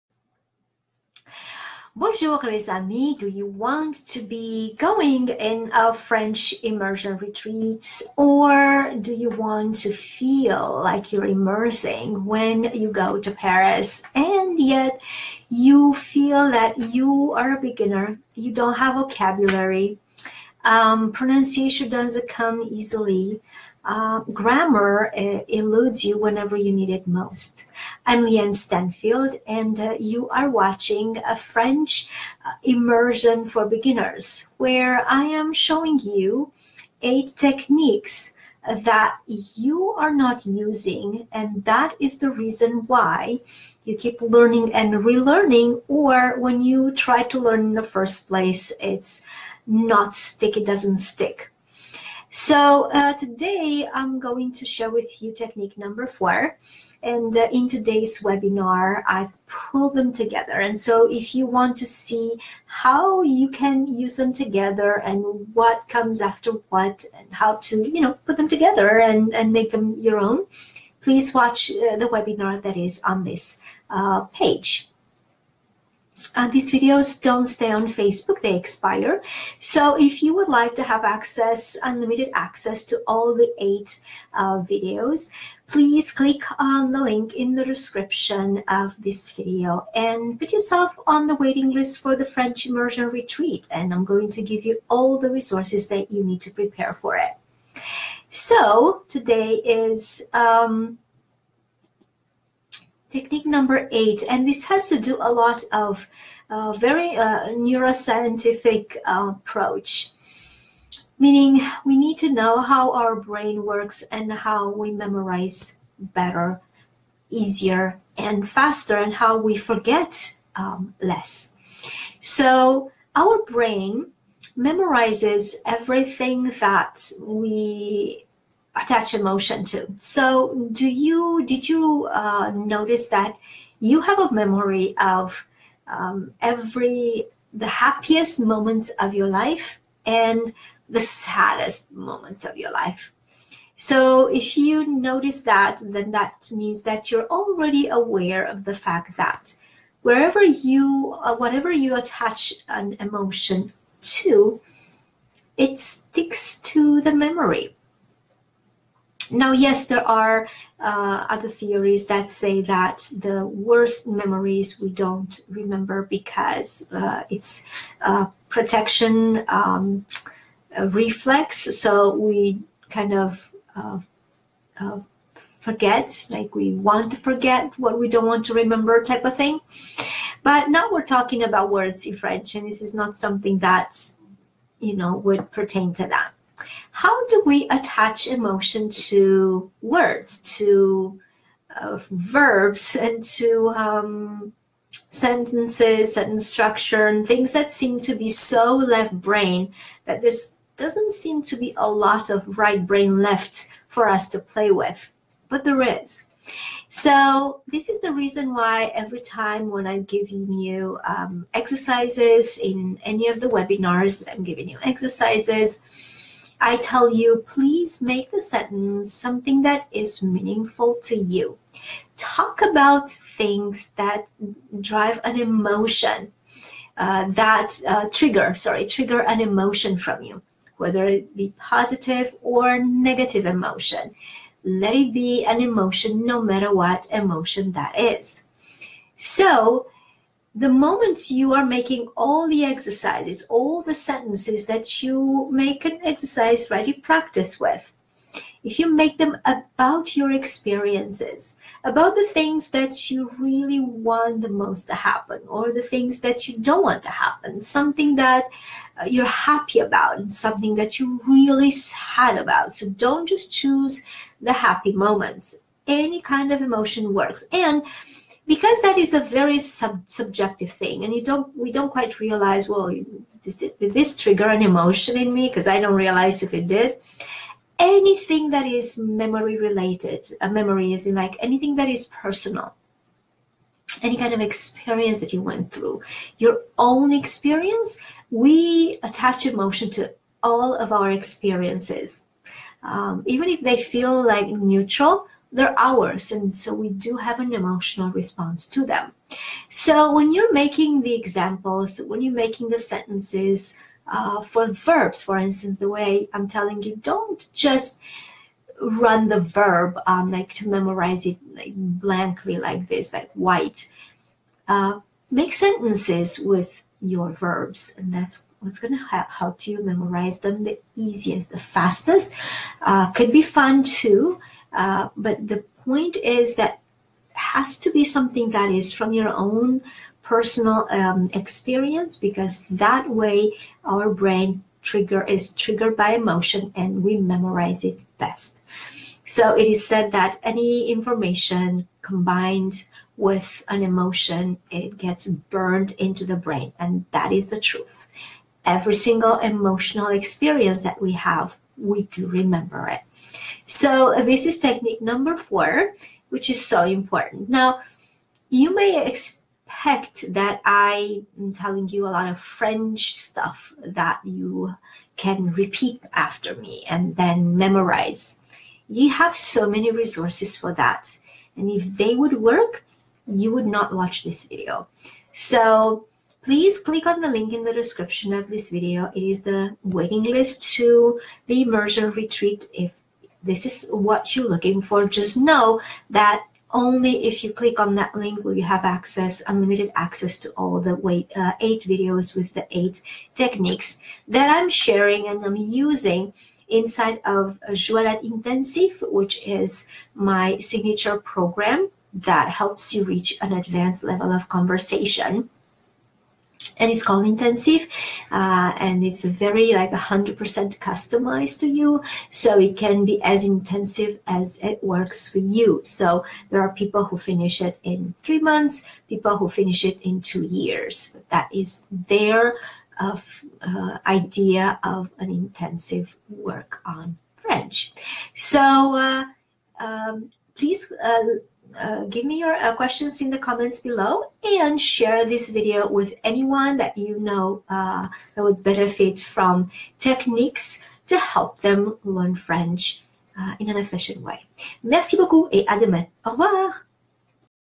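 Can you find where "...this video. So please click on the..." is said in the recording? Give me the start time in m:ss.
6:14.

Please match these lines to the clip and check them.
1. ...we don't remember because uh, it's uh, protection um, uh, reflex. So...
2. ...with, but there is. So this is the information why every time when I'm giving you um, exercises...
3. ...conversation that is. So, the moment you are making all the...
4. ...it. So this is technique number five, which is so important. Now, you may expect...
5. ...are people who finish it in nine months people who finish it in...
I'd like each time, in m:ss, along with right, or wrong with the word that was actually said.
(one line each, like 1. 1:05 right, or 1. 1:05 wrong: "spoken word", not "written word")
1. 2:44 right
2. 3:24 wrong: "reason", not "information"
3. 3:57 wrong: "emotion", not "conversation"
4. 5:52 wrong: "four", not "five"
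5. 6:56 wrong: "three", not "nine".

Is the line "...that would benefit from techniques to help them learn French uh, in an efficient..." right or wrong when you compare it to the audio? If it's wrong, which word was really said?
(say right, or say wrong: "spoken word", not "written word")
right.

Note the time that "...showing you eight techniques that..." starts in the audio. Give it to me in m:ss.
0:35.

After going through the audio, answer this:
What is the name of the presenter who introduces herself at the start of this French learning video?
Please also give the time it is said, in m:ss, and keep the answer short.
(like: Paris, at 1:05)
Llyane Stanfield, at 0:28.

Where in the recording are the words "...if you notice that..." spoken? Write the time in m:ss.
2:24.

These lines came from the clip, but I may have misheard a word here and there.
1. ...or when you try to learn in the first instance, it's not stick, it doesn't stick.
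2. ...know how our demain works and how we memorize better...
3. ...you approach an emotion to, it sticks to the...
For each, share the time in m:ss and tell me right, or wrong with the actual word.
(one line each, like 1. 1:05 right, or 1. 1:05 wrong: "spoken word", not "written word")
1. 0:45 wrong: "place", not "instance"
2. 1:52 wrong: "brain", not "demain"
3. 2:31 wrong: "attach", not "approach".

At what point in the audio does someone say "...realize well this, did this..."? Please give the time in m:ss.
4:32.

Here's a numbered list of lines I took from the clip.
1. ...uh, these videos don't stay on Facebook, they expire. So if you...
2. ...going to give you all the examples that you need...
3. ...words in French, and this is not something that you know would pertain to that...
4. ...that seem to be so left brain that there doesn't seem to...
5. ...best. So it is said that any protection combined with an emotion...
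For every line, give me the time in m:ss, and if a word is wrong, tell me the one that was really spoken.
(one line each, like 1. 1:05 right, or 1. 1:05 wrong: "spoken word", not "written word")
1. 1:16 right
2. 1:34 wrong: "resources", not "examples"
3. 3:01 right
4. 3:17 right
5. 5:38 wrong: "information", not "protection".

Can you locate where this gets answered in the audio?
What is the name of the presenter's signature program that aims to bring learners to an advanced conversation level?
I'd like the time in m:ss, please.
6:37.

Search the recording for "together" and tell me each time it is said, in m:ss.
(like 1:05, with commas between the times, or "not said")
1:00, 1:04, 1:08.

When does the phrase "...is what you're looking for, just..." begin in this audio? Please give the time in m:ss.
6:23.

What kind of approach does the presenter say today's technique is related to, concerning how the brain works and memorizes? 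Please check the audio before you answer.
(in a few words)
neuroscientific.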